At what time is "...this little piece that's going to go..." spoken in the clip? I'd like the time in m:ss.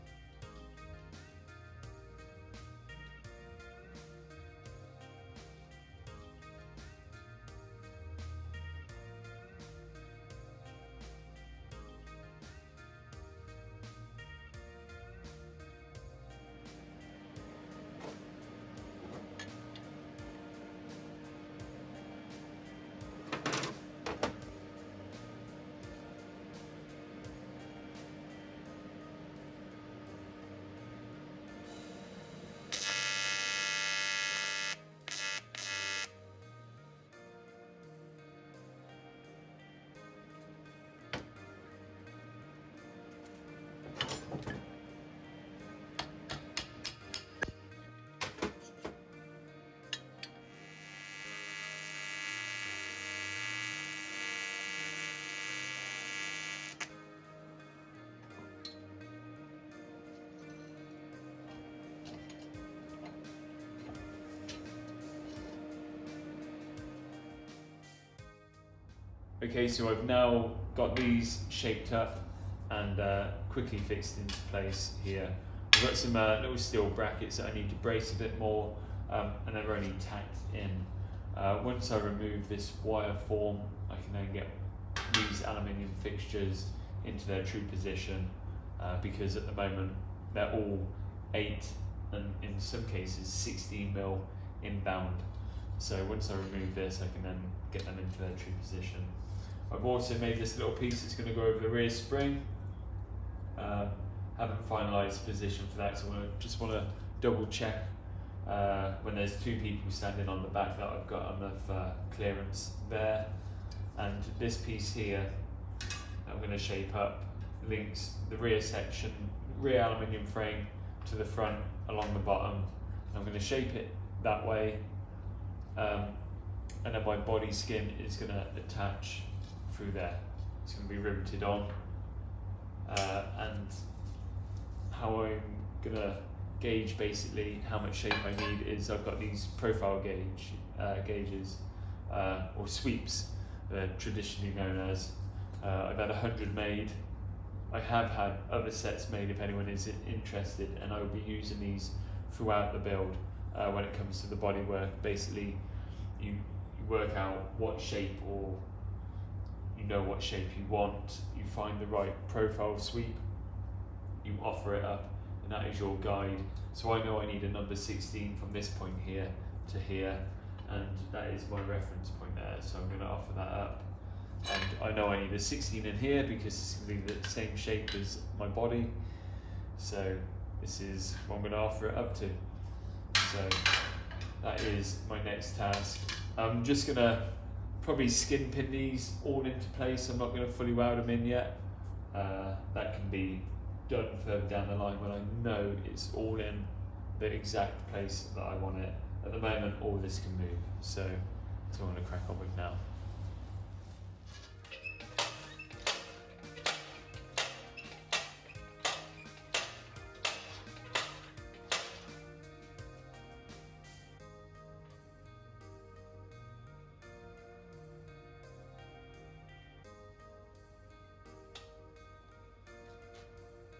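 1:40.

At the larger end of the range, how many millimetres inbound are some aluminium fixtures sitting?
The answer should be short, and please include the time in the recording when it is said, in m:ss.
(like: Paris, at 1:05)
16, at 1:33.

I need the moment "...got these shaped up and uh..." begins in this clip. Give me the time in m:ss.
1:10.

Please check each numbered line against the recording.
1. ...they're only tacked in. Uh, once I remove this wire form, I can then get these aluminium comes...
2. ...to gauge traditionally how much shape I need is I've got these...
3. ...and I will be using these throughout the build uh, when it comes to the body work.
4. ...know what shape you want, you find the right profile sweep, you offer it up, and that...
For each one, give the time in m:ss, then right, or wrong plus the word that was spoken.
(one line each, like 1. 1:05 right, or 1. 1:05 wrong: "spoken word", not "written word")
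1. 1:19 wrong: "fixtures", not "comes"
2. 2:15 wrong: "basically", not "traditionally"
3. 2:30 right
4. 2:39 right.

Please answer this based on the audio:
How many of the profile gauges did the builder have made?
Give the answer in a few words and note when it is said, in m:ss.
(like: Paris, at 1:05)
100, at 2:26.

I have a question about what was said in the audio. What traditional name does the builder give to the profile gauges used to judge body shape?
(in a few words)
Sweeps.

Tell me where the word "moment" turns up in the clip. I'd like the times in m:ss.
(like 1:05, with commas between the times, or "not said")
1:29, 3:19.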